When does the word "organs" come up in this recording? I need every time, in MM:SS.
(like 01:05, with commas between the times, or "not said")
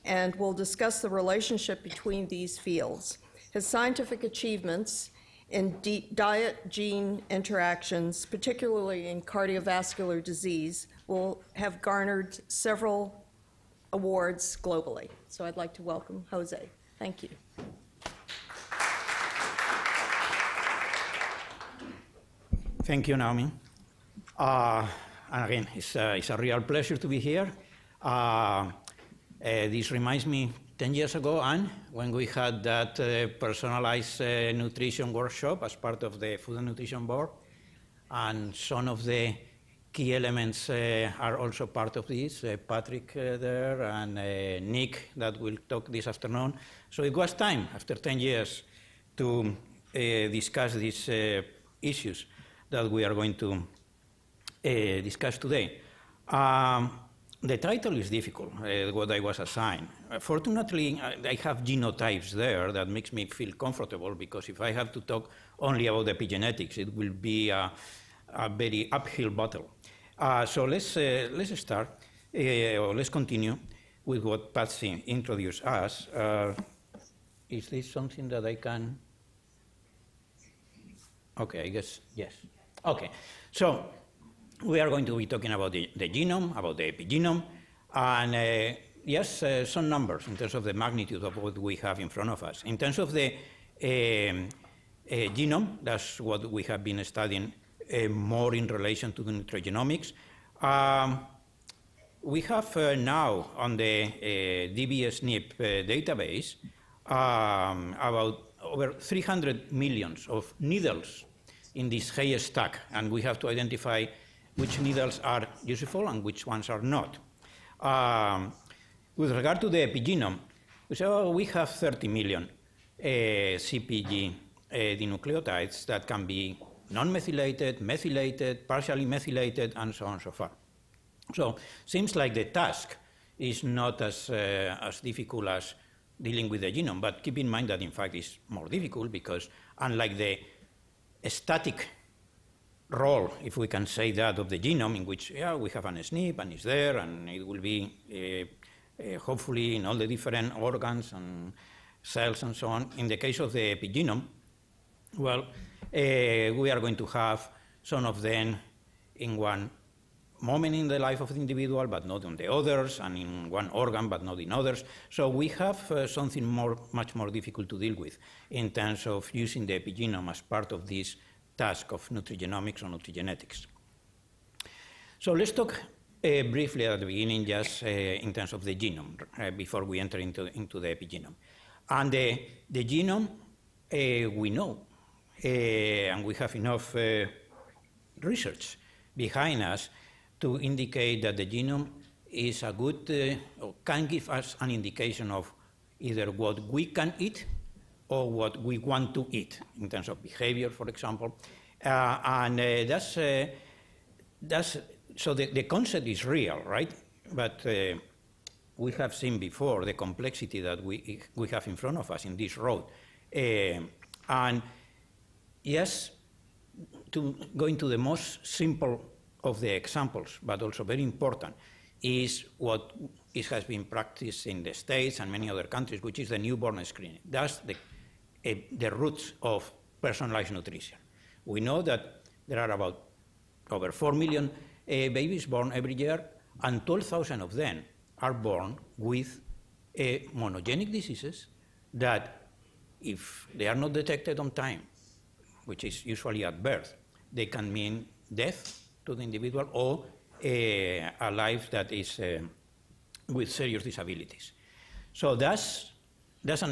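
02:30, 02:43.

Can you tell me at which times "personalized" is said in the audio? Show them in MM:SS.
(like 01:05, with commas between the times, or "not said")
00:33, 03:49.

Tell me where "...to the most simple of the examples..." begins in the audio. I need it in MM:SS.
03:37.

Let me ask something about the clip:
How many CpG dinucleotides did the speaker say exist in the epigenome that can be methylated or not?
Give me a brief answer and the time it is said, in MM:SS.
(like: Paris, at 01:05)
30 million, at 02:01.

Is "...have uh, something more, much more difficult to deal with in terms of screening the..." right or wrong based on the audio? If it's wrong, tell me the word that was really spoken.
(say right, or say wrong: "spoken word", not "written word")
wrong: "using", not "screening".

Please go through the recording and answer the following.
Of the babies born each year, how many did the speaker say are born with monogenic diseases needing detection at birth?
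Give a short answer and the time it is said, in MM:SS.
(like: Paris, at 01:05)
12,000, at 03:56.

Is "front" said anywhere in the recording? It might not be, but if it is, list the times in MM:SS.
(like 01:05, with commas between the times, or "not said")
01:32, 03:31.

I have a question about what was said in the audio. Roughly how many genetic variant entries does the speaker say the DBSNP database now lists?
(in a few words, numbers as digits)
over 300 million.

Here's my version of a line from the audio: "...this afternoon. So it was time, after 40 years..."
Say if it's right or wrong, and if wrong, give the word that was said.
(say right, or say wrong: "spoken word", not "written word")
wrong: "10", not "40".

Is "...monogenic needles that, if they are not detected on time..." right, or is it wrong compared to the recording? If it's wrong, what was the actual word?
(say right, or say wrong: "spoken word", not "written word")
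wrong: "diseases", not "needles".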